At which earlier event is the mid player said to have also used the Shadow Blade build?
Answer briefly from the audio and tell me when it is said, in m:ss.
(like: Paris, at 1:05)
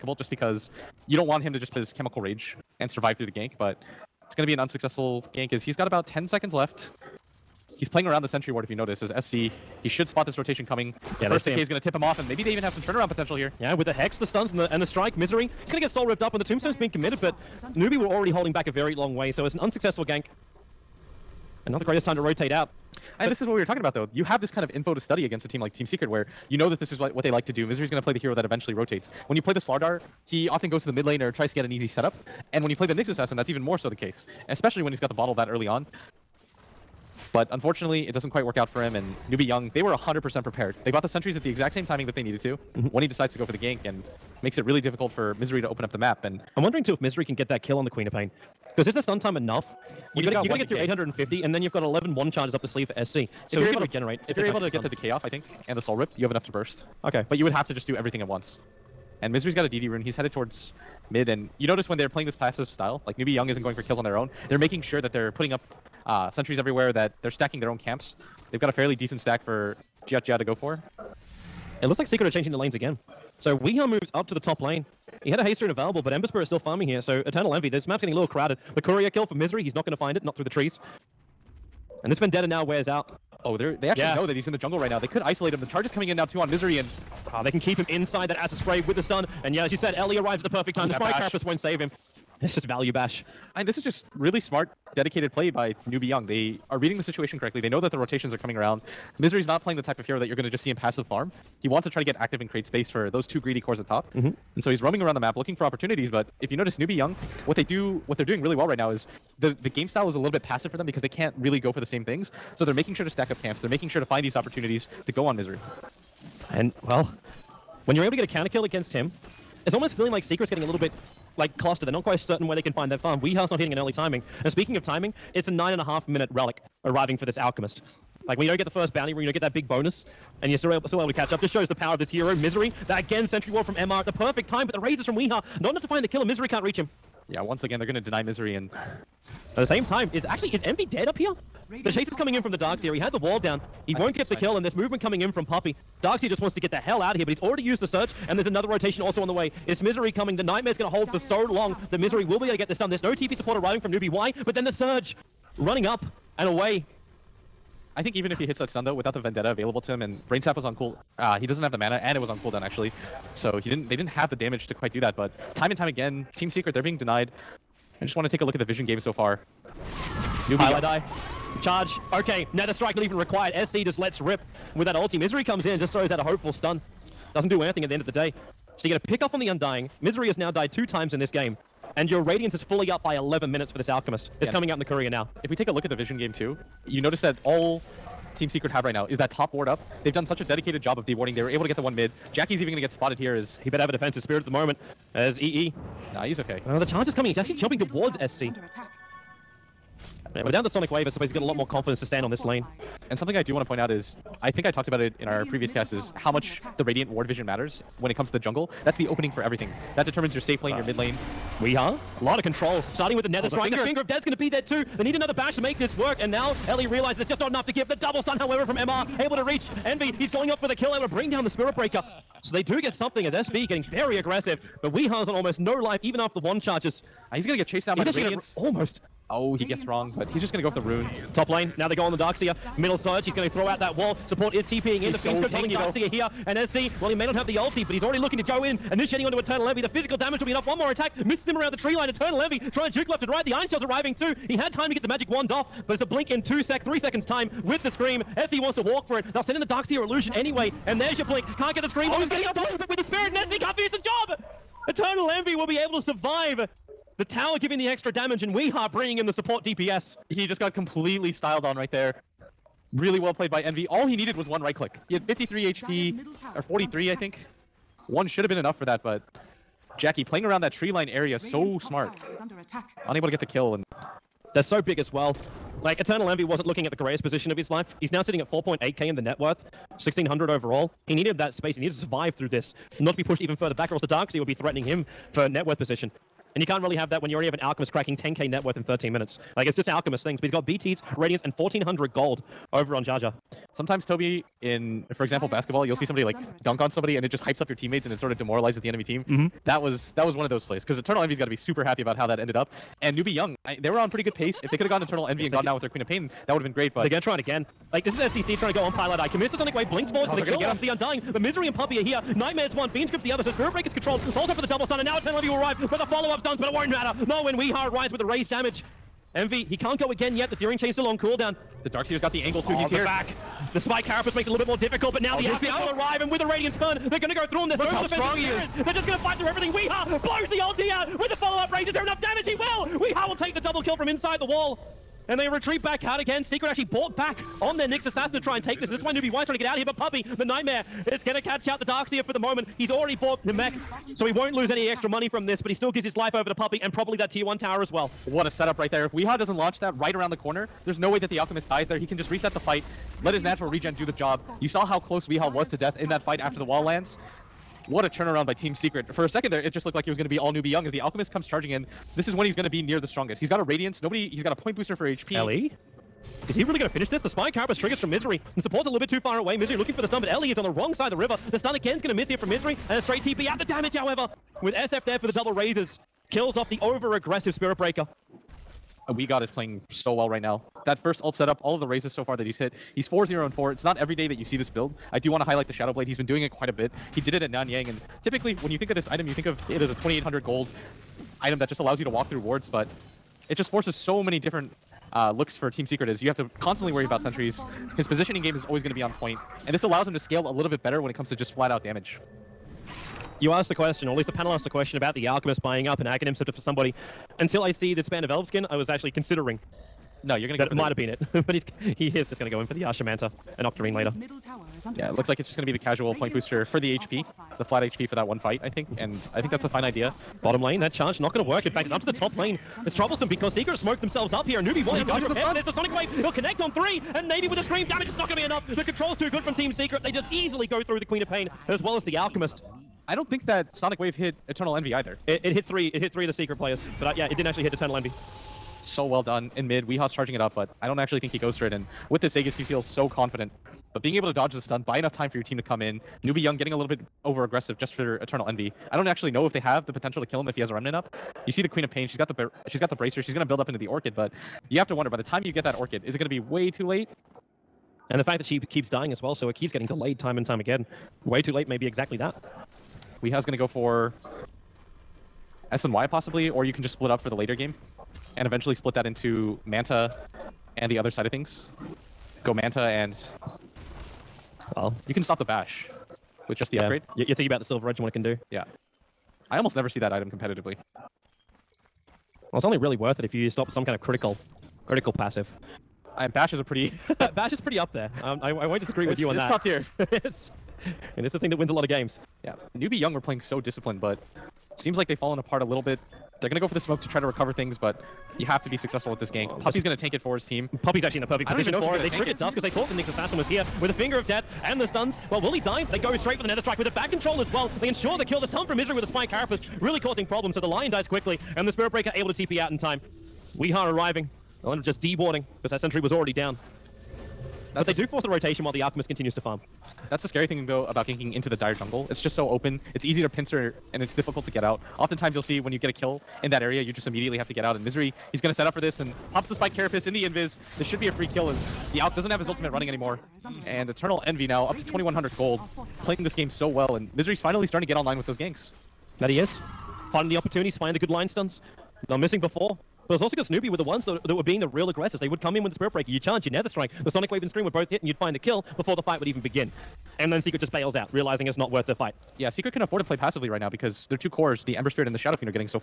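Nanyang, at 6:27.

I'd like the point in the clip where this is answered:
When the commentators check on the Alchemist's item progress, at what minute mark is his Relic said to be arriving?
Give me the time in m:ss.
2:05.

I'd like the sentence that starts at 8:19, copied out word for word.
gonna tank it for his team.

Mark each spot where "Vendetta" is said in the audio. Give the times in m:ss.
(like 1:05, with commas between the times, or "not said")
1:22, 2:39.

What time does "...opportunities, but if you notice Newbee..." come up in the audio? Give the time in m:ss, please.
1:45.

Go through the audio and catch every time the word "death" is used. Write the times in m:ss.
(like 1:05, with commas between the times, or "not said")
3:34, 5:55, 8:24.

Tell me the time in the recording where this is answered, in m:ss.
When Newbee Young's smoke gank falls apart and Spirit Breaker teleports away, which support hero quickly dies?
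8:30.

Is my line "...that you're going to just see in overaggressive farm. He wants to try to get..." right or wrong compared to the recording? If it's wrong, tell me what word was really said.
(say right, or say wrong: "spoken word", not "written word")
wrong: "passive", not "overaggressive".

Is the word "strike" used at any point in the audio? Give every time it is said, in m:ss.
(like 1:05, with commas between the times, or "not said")
0:14, 2:52, 3:33, 8:26, 9:06.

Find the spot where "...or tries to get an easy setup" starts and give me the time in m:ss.
0:31.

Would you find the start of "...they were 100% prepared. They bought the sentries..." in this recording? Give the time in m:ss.
0:39.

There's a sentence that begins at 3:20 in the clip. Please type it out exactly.
Yeah, without the Sonic Wave, I suppose he's got a lot more confidence to stand on this lane.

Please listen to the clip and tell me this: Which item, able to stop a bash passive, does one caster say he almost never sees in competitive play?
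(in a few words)
Silver Edge.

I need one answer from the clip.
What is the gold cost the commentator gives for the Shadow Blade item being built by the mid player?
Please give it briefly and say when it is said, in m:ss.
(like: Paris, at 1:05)
2800, at 6:29.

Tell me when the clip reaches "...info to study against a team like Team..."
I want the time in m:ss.
0:24.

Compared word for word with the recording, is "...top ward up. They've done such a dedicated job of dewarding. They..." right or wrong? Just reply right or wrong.
right.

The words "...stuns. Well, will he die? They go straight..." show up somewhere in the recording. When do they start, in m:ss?
8:24.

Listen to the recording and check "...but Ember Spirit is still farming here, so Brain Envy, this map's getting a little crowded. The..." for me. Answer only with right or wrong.
wrong.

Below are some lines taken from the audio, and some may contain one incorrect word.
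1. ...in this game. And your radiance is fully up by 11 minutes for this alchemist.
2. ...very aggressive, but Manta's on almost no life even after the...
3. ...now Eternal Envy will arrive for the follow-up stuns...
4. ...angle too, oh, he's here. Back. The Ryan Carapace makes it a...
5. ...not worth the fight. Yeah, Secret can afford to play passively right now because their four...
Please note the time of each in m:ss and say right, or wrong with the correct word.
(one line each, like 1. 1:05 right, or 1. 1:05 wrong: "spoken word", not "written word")
1. 3:01 right
2. 3:43 wrong: "Weeha", not "Manta"
3. 5:15 right
4. 5:22 wrong: "Spiked", not "Ryan"
5. 9:11 wrong: "two", not "four".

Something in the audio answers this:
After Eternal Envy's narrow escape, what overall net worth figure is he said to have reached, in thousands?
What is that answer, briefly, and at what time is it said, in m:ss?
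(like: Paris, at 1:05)
4.8k, at 4:38.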